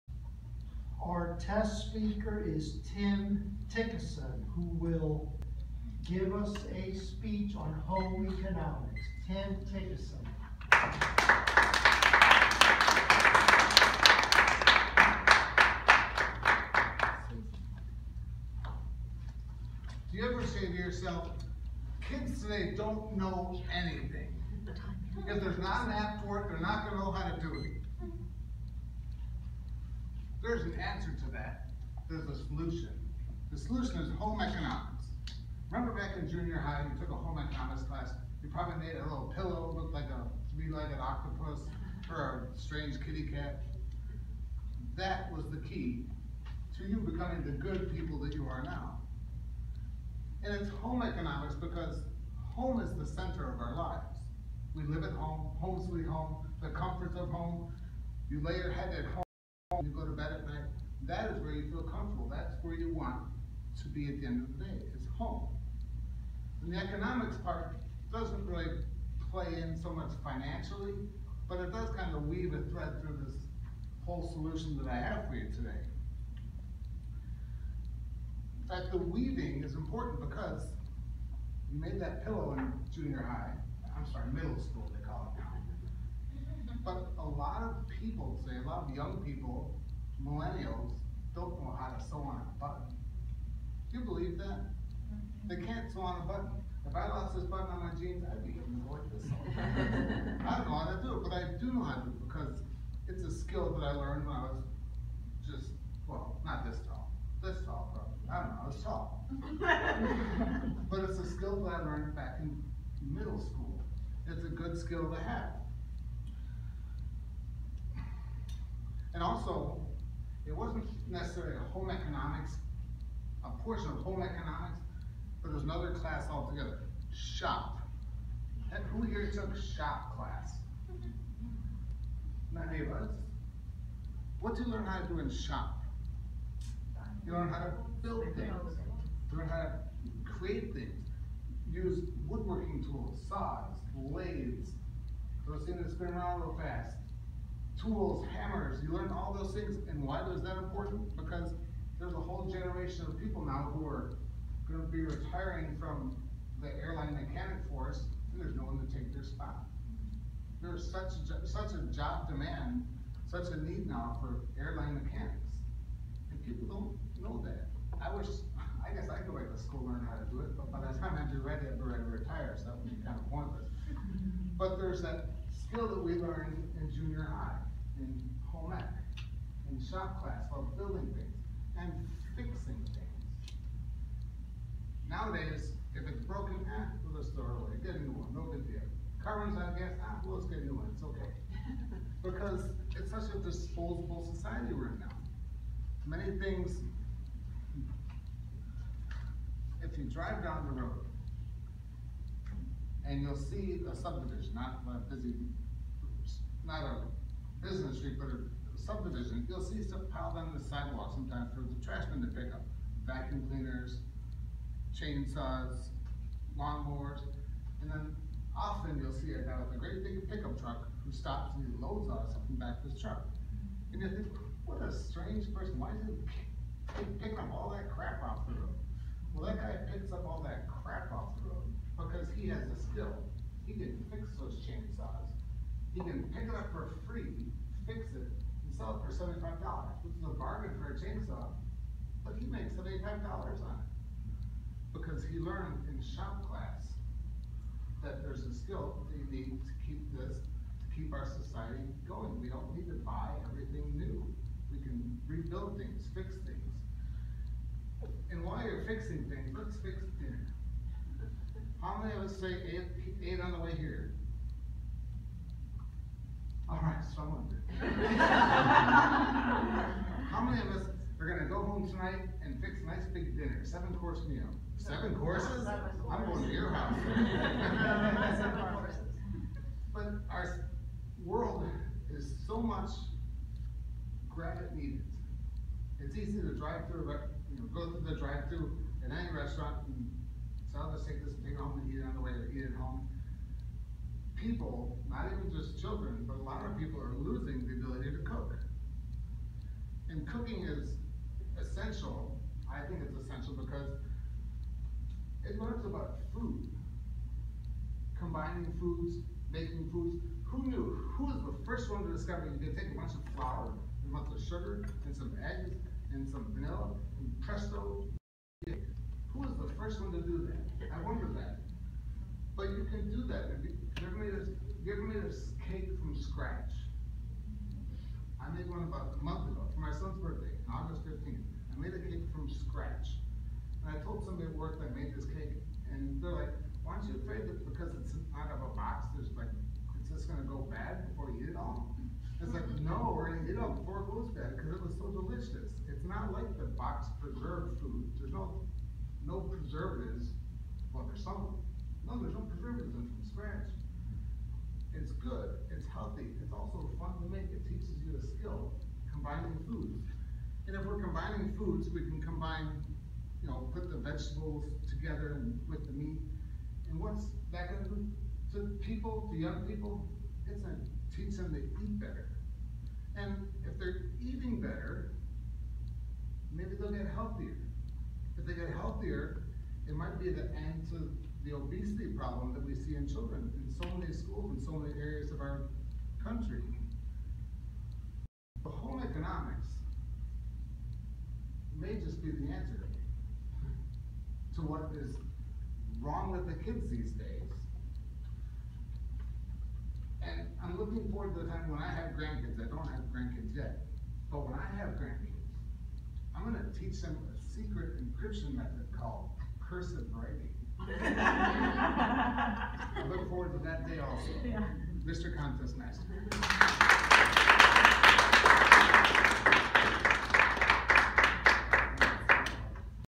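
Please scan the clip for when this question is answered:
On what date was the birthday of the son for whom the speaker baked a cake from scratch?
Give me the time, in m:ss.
5:30.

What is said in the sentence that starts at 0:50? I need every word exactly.
And it's home economics because home is the center of our lives.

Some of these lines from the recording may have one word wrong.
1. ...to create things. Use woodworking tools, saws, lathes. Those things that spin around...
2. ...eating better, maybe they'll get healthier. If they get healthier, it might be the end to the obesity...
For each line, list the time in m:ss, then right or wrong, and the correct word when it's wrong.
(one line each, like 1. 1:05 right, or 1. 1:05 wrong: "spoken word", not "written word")
1. 2:19 right
2. 6:14 right.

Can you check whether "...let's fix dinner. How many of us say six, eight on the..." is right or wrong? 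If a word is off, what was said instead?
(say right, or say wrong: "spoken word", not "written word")
wrong: "eight", not "six".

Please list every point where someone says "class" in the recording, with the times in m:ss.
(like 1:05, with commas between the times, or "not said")
0:37, 2:05, 2:10, 3:00, 4:06.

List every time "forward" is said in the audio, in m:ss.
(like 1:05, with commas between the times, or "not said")
6:41, 6:53.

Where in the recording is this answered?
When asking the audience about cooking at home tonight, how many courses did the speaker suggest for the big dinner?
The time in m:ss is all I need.
4:33.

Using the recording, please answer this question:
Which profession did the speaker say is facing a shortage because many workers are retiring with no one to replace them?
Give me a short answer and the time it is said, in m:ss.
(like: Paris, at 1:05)
airline mechanics, at 2:36.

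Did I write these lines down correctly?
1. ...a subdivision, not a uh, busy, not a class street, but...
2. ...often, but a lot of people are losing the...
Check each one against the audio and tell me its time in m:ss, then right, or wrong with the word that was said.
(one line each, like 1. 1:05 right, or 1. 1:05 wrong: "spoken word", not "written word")
1. 3:23 wrong: "business", not "class"
2. 4:55 wrong: "children", not "often".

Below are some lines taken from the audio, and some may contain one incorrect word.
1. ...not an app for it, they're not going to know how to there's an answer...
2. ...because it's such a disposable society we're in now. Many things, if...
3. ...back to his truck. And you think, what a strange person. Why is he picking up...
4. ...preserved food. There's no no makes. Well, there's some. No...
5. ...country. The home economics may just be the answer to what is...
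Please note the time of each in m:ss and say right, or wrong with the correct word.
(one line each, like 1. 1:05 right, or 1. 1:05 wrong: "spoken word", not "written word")
1. 0:25 right
2. 3:12 right
3. 3:42 right
4. 5:47 wrong: "preservatives", not "makes"
5. 6:26 right.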